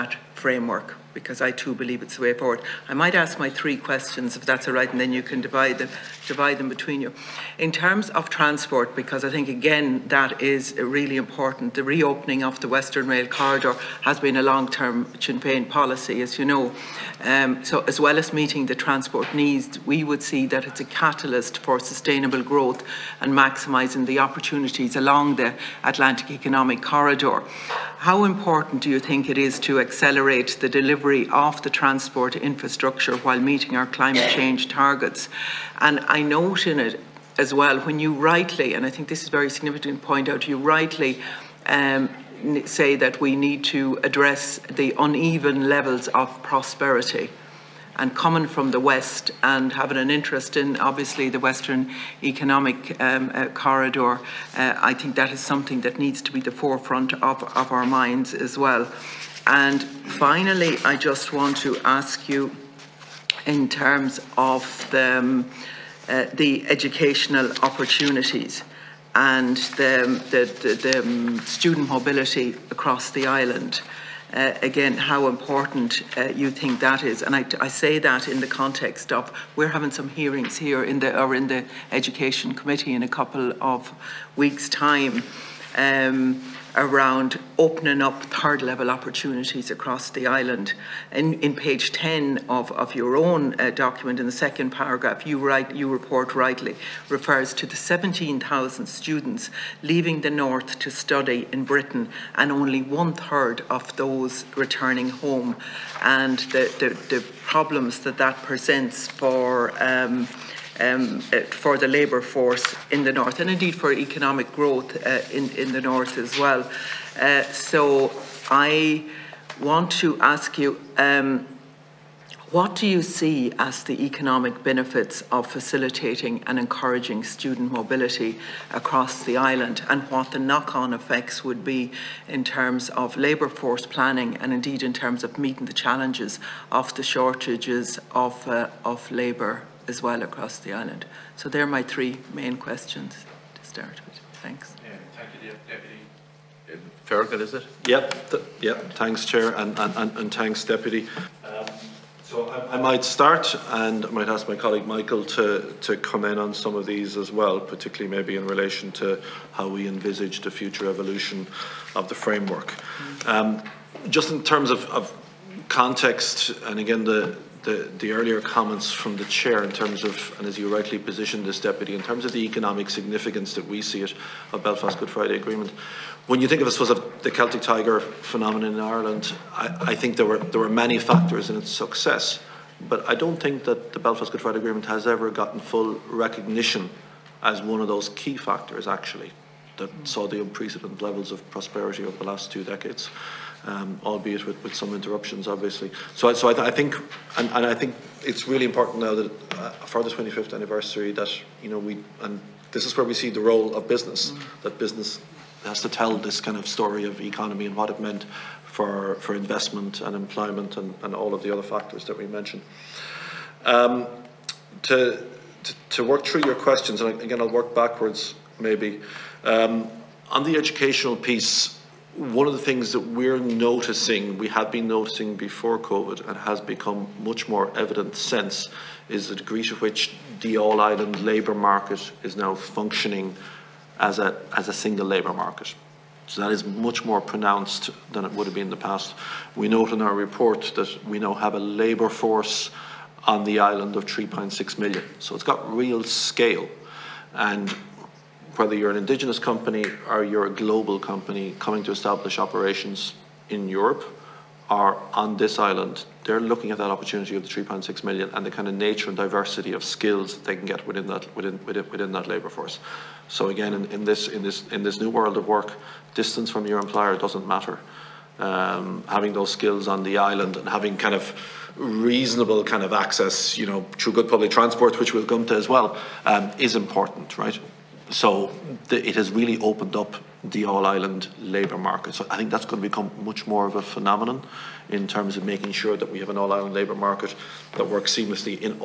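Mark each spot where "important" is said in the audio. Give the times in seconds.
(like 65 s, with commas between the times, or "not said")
11 s, 28 s, 75 s, 198 s, 276 s.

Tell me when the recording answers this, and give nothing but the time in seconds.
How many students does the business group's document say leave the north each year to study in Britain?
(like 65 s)
97 s.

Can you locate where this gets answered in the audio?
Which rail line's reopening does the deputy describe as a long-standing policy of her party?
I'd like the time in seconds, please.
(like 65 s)
12 s.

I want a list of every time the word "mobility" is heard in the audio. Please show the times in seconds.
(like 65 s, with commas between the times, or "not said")
71 s, 127 s.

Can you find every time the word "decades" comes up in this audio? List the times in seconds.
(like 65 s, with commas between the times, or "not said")
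192 s.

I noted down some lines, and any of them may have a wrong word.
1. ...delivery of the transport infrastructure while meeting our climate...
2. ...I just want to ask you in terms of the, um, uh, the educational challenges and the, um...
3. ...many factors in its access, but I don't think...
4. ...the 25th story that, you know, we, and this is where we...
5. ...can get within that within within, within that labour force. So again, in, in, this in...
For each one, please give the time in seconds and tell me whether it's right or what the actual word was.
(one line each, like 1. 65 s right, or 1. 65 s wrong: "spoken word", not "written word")
1. 31 s right
2. 60 s wrong: "opportunities", not "challenges"
3. 180 s wrong: "success", not "access"
4. 200 s wrong: "anniversary", not "story"
5. 260 s right.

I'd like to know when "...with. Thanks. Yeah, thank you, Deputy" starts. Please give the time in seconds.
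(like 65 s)
144 s.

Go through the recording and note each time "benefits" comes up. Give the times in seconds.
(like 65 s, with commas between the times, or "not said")
124 s.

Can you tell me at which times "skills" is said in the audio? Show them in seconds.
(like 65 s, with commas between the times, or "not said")
259 s, 269 s.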